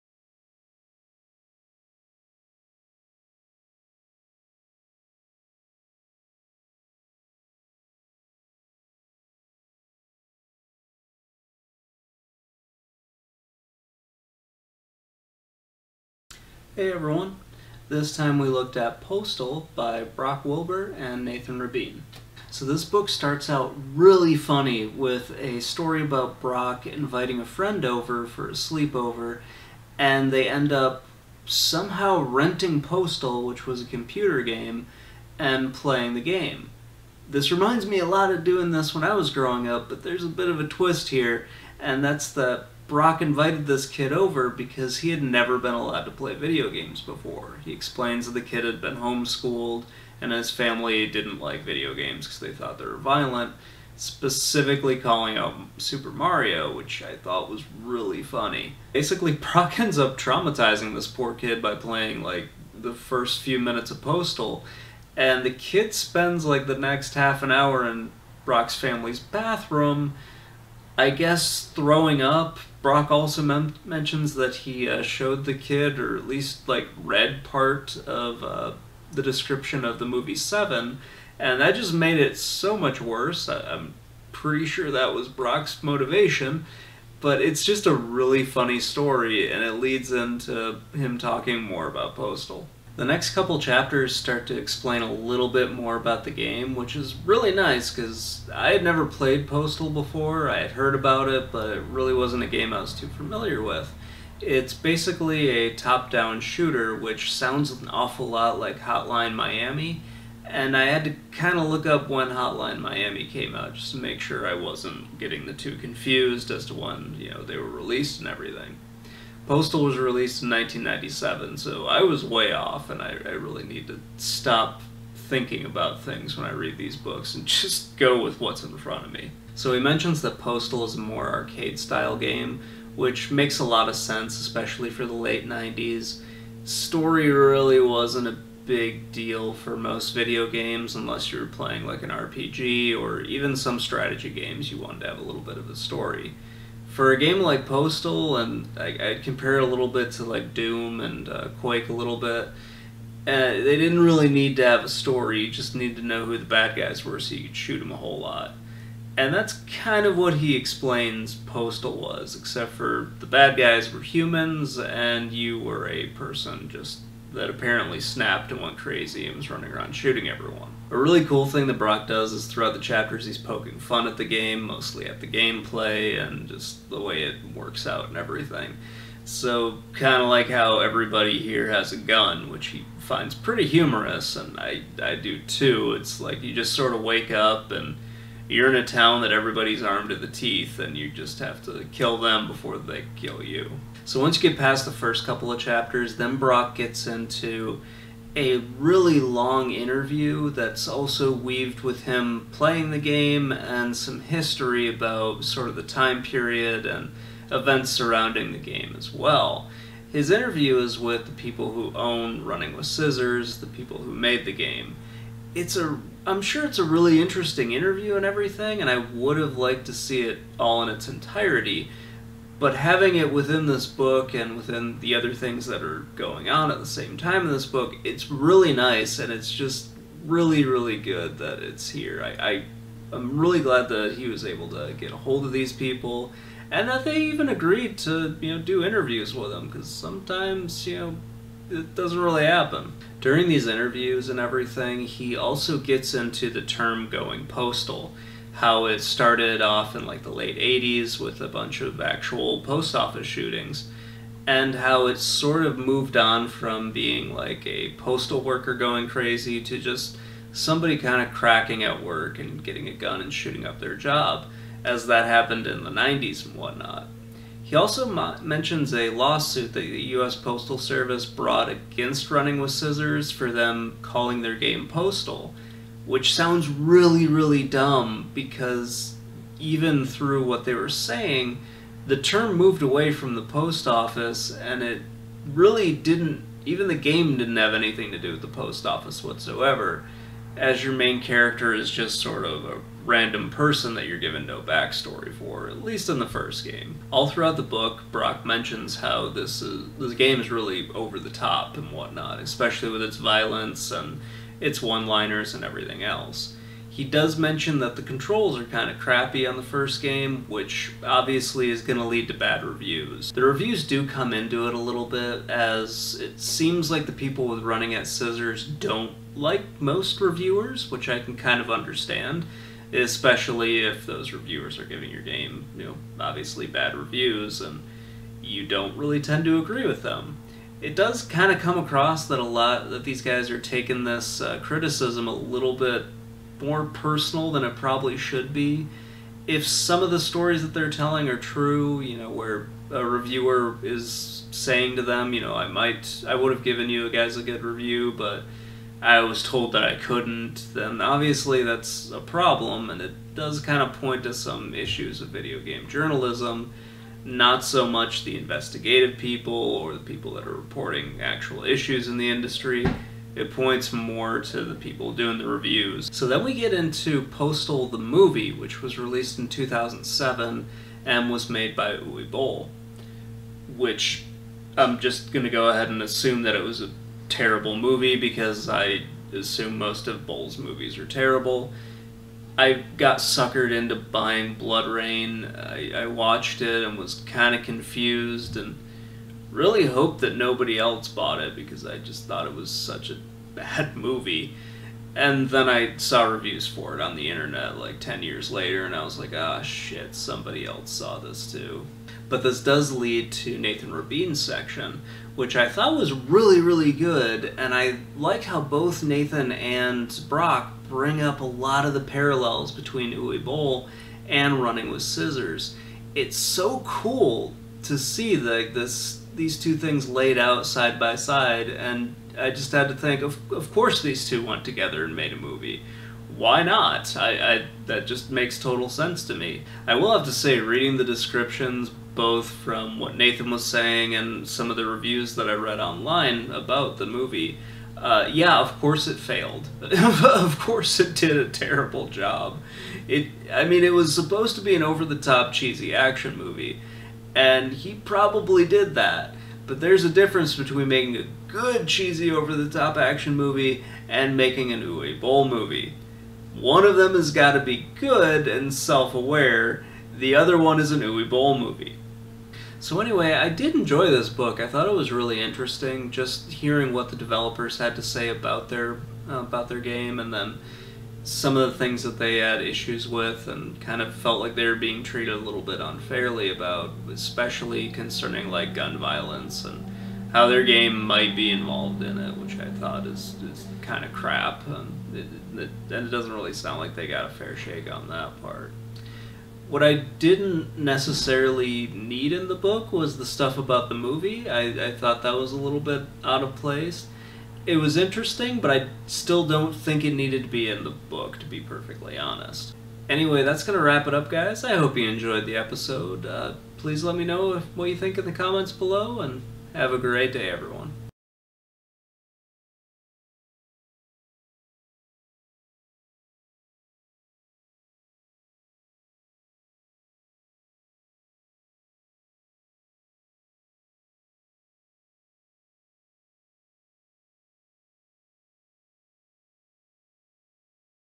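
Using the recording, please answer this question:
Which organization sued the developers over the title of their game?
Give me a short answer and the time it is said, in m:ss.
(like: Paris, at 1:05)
U.S. Postal Service, at 4:30.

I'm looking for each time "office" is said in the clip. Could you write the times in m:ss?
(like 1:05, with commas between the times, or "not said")
4:12, 4:43, 4:48.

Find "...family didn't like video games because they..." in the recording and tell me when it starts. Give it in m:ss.
0:50.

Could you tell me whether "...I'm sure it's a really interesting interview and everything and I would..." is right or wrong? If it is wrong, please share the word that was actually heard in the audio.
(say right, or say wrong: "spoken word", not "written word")
right.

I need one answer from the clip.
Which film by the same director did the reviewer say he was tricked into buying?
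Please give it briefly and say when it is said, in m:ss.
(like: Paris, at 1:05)
BloodRayne, at 6:24.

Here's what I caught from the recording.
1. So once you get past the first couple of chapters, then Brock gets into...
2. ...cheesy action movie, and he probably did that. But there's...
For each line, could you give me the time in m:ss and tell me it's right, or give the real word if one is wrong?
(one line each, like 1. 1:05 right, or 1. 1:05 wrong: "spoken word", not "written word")
1. 3:14 right
2. 7:25 right.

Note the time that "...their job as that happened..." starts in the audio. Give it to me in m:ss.
4:23.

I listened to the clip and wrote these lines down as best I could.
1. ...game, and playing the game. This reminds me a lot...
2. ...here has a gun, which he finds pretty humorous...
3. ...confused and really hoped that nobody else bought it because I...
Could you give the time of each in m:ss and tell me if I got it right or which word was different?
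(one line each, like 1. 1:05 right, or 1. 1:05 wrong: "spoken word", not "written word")
1. 0:34 right
2. 3:01 right
3. 6:27 right.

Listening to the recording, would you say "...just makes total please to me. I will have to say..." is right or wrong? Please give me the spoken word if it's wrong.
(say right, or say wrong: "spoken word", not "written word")
wrong: "sense", not "please".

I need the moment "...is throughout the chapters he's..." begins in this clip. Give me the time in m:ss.
2:52.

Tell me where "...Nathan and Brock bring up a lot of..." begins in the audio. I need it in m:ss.
6:49.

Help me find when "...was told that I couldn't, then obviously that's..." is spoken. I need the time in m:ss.
5:49.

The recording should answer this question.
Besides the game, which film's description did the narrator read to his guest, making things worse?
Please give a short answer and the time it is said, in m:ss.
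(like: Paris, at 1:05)
Seven, at 1:20.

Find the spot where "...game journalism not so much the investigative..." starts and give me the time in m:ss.
5:55.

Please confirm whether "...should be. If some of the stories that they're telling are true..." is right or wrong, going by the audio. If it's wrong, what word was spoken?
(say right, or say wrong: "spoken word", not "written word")
right.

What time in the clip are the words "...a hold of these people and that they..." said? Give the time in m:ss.
3:55.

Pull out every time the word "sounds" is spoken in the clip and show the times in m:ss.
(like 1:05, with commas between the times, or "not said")
1:47, 4:36, 8:06.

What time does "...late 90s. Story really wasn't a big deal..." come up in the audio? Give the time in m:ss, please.
2:15.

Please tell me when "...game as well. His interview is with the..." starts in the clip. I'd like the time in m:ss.
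3:28.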